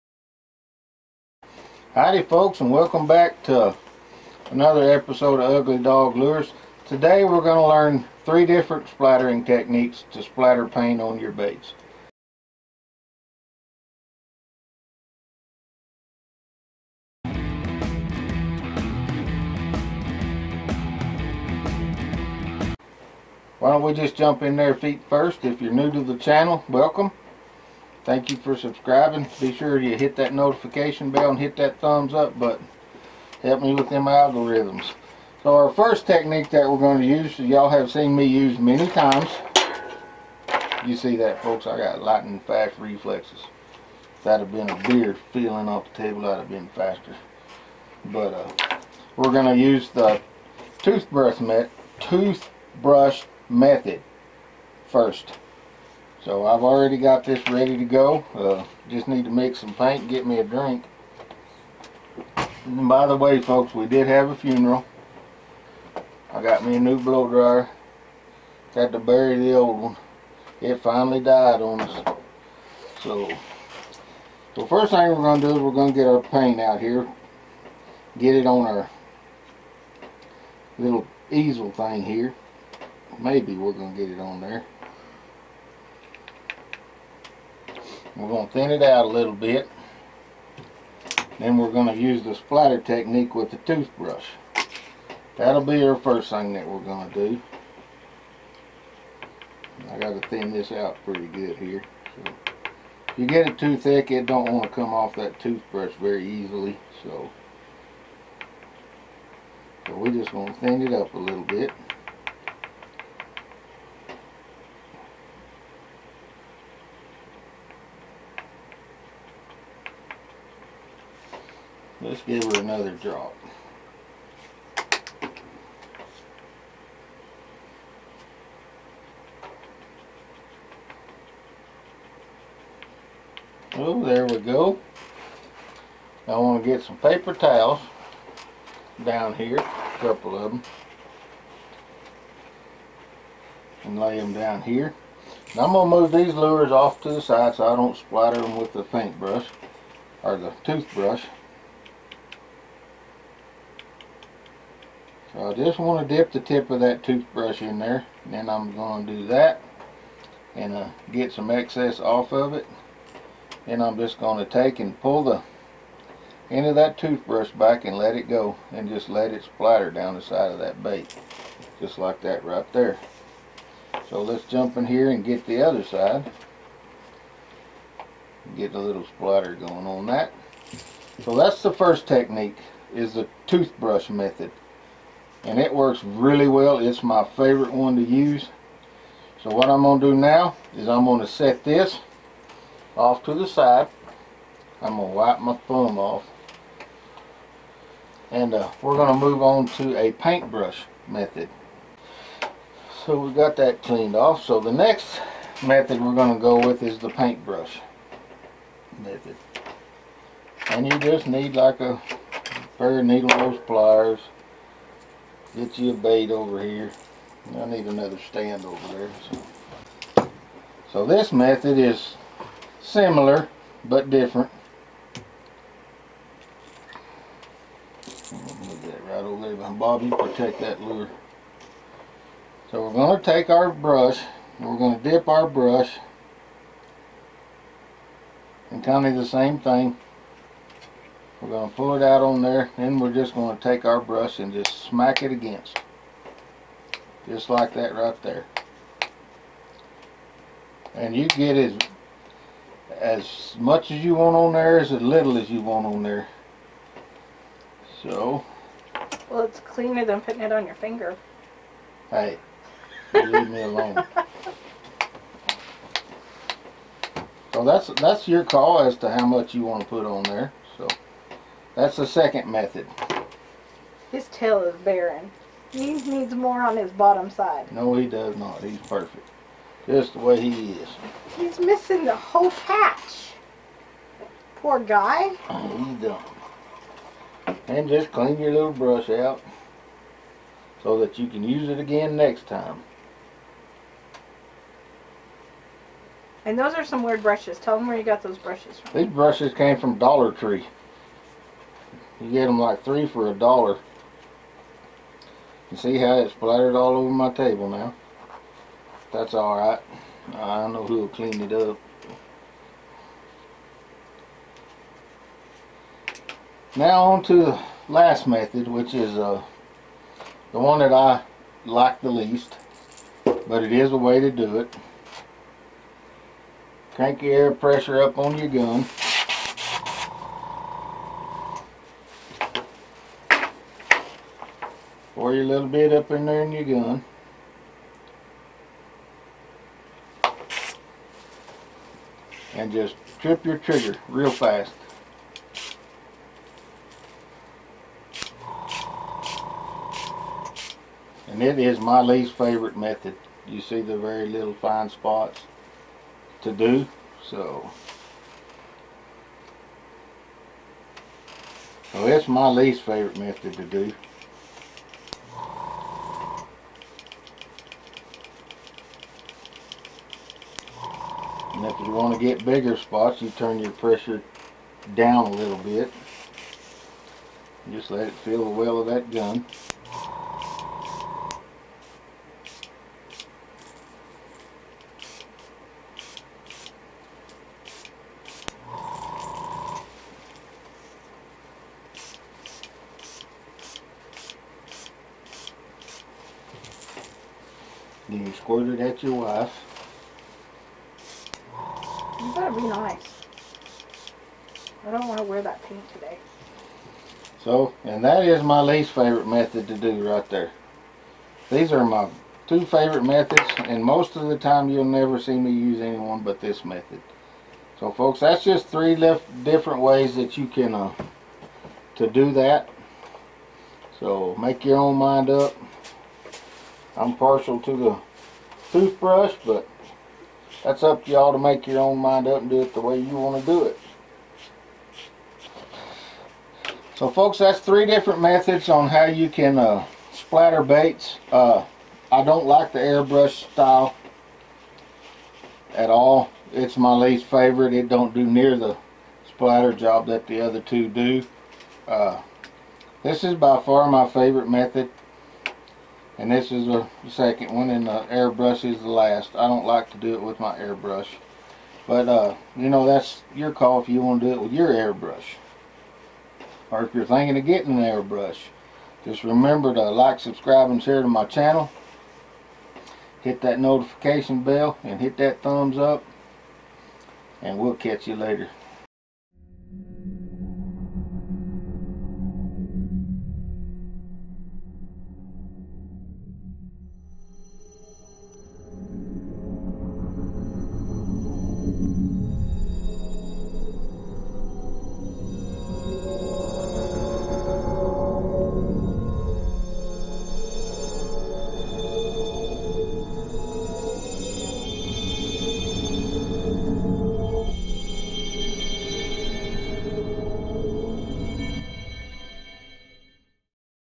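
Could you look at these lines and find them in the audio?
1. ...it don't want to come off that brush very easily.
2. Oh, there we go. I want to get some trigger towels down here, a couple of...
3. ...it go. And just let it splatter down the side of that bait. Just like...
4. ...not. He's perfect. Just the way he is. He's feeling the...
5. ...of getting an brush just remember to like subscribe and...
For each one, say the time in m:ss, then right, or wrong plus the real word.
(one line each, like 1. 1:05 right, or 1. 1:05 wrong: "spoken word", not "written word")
1. 1:44 wrong: "toothbrush", not "brush"
2. 2:13 wrong: "paper", not "trigger"
3. 2:48 right
4. 4:38 wrong: "missing", not "feeling"
5. 7:47 wrong: "airbrush", not "brush".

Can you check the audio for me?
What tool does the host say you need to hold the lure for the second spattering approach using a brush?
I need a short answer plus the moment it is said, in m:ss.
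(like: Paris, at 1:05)
Needle nose pliers, at 3:33.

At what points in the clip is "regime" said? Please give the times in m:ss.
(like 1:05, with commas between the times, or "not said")
not said.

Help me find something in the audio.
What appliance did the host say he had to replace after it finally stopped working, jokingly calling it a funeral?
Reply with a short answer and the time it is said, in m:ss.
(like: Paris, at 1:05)
Blow dryer, at 1:06.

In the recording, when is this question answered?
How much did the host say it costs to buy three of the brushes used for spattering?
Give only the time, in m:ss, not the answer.
5:03.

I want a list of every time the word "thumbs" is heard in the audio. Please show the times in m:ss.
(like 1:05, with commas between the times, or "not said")
0:31, 3:15, 7:55.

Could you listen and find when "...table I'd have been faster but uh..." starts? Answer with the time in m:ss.
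0:46.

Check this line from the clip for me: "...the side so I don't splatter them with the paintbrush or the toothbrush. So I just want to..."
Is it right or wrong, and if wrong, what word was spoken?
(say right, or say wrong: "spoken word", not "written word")
right.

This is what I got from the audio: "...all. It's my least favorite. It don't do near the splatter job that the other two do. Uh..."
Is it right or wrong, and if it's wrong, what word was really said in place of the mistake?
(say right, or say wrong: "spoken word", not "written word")
right.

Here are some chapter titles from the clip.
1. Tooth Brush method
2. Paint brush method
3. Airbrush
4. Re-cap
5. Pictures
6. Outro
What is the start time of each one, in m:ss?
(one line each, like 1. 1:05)
1. 0:23
2. 3:20
3. 5:17
4. 7:17
5. 7:59
6. 8:14.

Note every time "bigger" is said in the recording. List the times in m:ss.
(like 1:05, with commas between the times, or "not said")
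6:12.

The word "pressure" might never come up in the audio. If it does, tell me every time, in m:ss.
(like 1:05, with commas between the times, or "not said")
5:27, 6:13.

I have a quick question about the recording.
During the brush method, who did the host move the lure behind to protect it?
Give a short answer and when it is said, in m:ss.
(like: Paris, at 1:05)
Bob, at 3:49.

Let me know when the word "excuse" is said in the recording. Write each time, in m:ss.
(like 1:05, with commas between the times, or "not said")
not said.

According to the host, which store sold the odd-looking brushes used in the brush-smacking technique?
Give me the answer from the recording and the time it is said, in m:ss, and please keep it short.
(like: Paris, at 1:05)
Dollar Tree, at 4:59.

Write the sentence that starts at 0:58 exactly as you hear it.
Uh, just need to mix some paint get me a drink.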